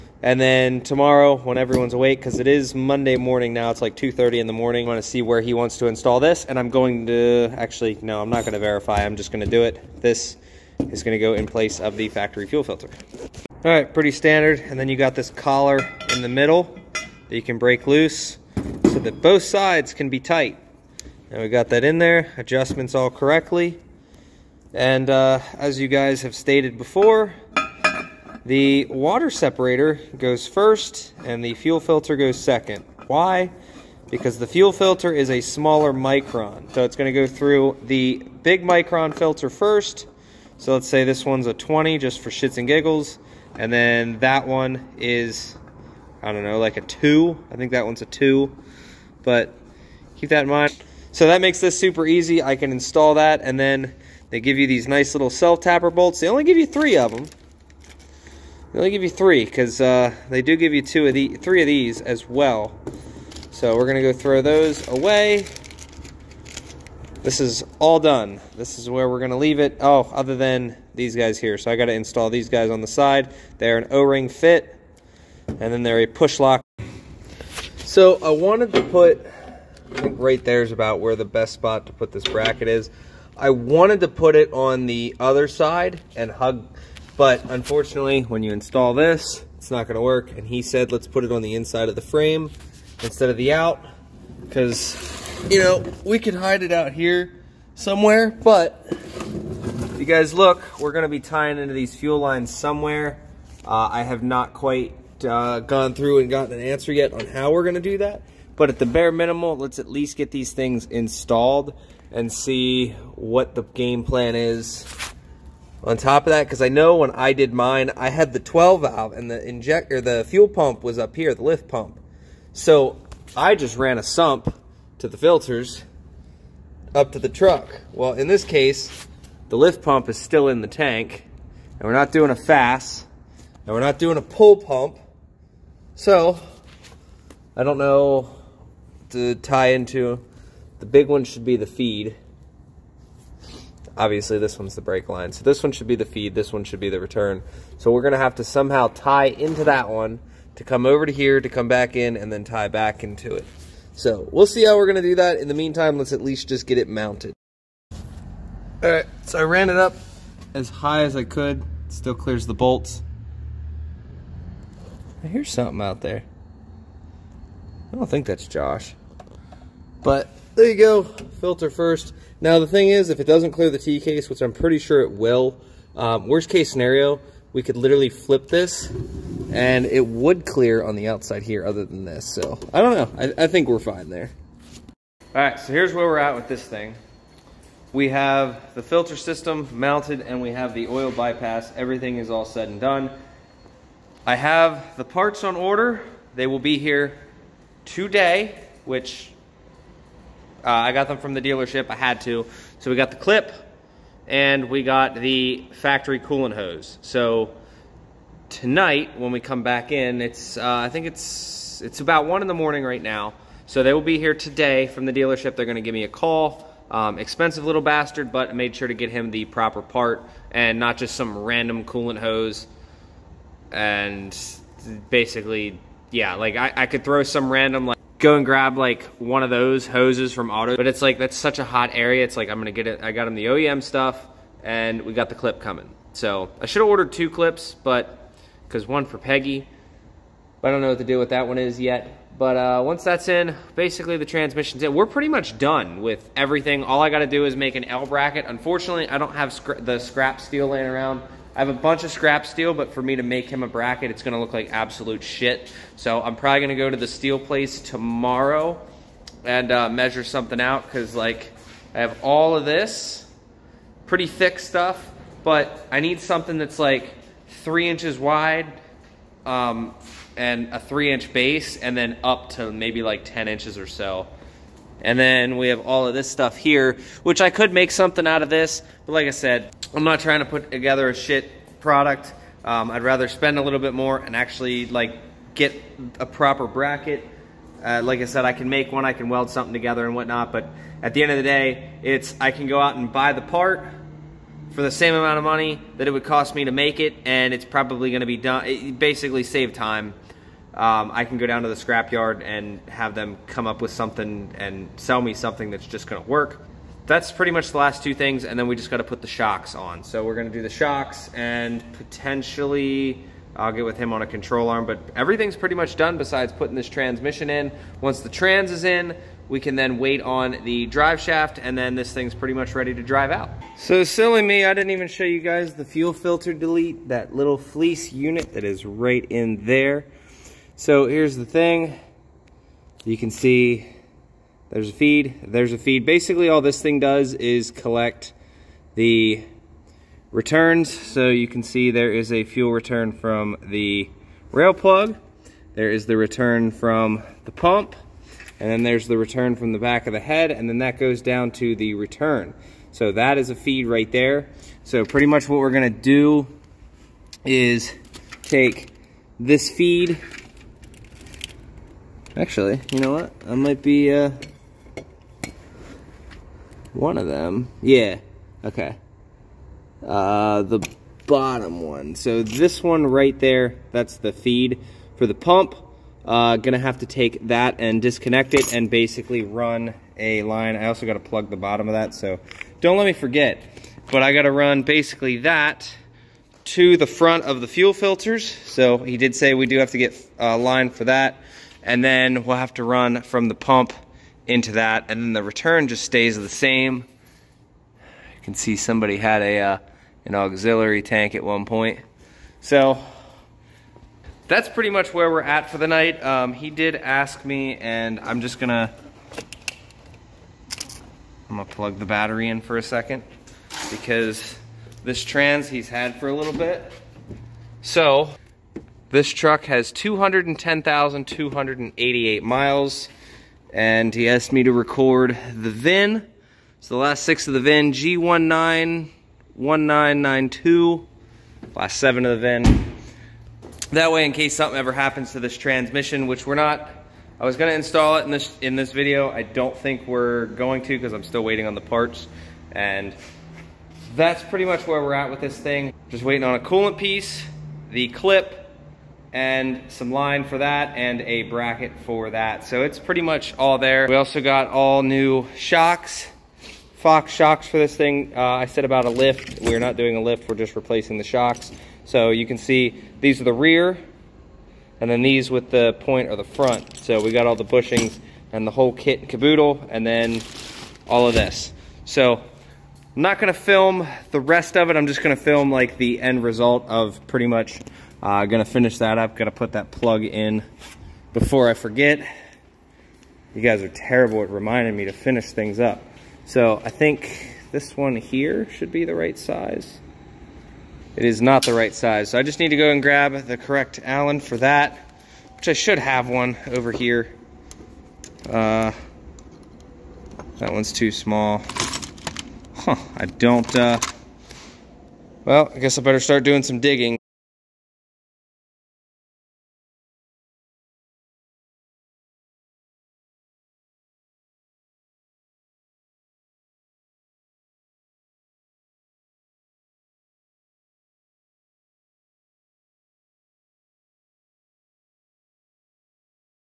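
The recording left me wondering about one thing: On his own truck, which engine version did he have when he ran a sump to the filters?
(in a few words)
12 valve.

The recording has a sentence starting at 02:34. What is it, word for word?
So we'll see how we're going to do that.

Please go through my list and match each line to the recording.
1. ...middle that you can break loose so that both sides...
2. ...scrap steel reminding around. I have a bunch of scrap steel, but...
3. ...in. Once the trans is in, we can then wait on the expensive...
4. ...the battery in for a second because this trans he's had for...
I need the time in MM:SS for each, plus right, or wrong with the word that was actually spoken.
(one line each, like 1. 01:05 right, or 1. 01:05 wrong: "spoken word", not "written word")
1. 00:16 right
2. 04:09 wrong: "laying", not "reminding"
3. 05:17 wrong: "drive", not "expensive"
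4. 06:52 right.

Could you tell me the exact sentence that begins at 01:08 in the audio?
This is where we're going to leave it.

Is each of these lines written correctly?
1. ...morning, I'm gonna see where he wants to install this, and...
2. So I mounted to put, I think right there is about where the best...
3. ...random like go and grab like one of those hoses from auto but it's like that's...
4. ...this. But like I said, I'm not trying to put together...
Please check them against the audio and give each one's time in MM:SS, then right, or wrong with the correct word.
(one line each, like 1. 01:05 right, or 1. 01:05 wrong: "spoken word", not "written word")
1. 00:04 right
2. 01:17 wrong: "wanted", not "mounted"
3. 03:47 right
4. 04:38 right.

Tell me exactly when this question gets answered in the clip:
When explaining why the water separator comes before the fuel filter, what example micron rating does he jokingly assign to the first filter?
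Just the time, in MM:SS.
00:41.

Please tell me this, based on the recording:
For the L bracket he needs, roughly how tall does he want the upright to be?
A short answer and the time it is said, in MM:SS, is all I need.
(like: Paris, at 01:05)
10 inches, at 04:33.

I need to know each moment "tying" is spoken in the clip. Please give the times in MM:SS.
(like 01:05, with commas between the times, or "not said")
01:41.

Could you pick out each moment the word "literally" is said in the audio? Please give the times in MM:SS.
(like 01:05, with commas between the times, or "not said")
02:57.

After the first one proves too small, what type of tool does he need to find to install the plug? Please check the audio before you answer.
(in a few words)
Allen.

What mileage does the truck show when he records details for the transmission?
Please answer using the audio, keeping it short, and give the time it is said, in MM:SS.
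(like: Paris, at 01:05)
210,288 miles, at 06:59.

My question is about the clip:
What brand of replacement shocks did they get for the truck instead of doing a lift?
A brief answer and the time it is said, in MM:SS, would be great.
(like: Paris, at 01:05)
Fox, at 07:36.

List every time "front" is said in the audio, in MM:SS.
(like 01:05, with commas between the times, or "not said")
06:27, 07:46.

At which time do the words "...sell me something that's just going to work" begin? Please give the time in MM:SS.
05:04.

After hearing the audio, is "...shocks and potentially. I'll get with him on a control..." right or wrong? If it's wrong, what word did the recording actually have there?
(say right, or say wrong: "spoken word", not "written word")
right.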